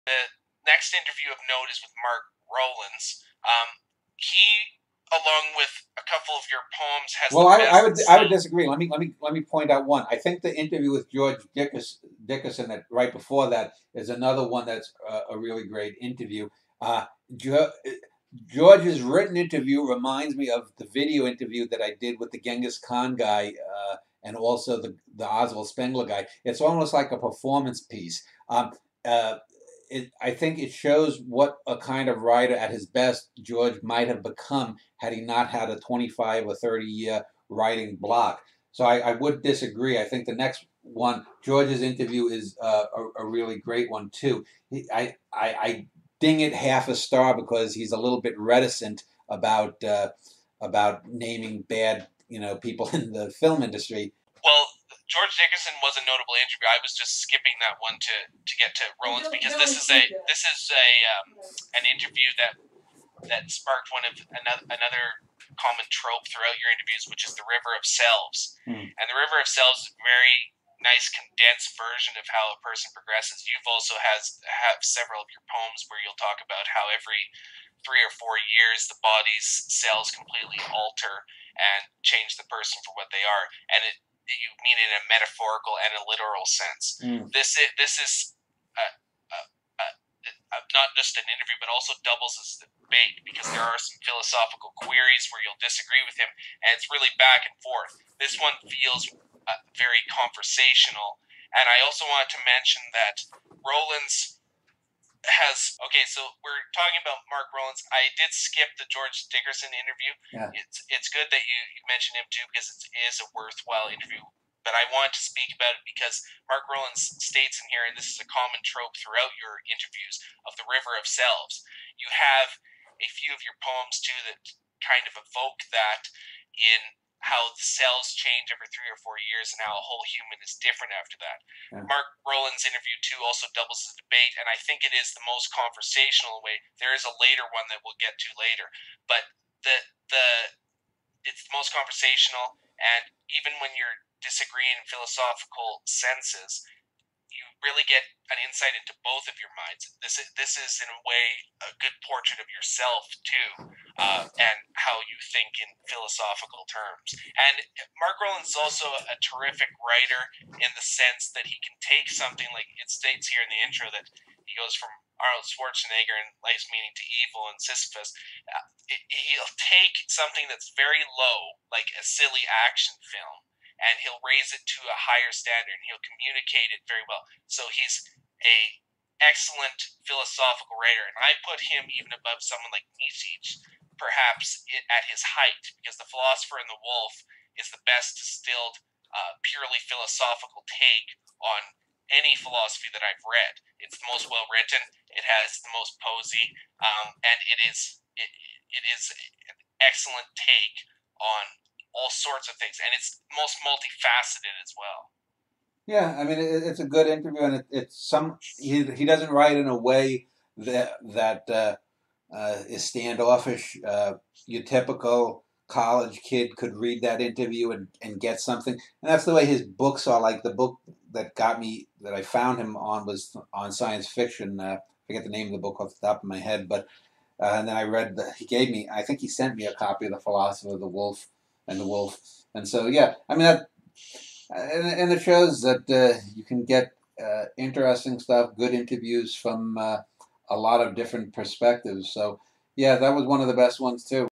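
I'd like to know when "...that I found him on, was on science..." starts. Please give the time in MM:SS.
03:42.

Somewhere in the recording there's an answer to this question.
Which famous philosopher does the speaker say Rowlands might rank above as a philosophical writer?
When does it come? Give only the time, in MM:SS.
03:02.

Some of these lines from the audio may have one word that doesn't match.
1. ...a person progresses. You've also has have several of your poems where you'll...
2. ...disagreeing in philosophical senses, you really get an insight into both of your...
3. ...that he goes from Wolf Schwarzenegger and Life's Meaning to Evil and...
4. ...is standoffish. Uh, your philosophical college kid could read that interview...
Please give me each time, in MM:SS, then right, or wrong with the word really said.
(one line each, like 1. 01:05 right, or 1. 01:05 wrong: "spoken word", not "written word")
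1. 01:12 right
2. 02:24 right
3. 02:43 wrong: "Arnold", not "Wolf"
4. 03:32 wrong: "typical", not "philosophical".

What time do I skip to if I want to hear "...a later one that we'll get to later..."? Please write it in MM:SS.
02:17.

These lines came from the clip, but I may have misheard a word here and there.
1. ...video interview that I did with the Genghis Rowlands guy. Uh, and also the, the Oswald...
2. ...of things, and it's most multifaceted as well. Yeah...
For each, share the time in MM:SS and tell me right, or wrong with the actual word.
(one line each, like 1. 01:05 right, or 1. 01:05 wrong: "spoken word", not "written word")
1. 00:20 wrong: "Khan", not "Rowlands"
2. 03:22 right.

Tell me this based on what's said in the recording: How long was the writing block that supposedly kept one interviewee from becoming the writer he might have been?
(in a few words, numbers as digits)
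25 or 30 years.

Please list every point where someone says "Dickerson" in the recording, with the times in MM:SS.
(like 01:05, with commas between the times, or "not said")
00:11, 00:55, 01:49.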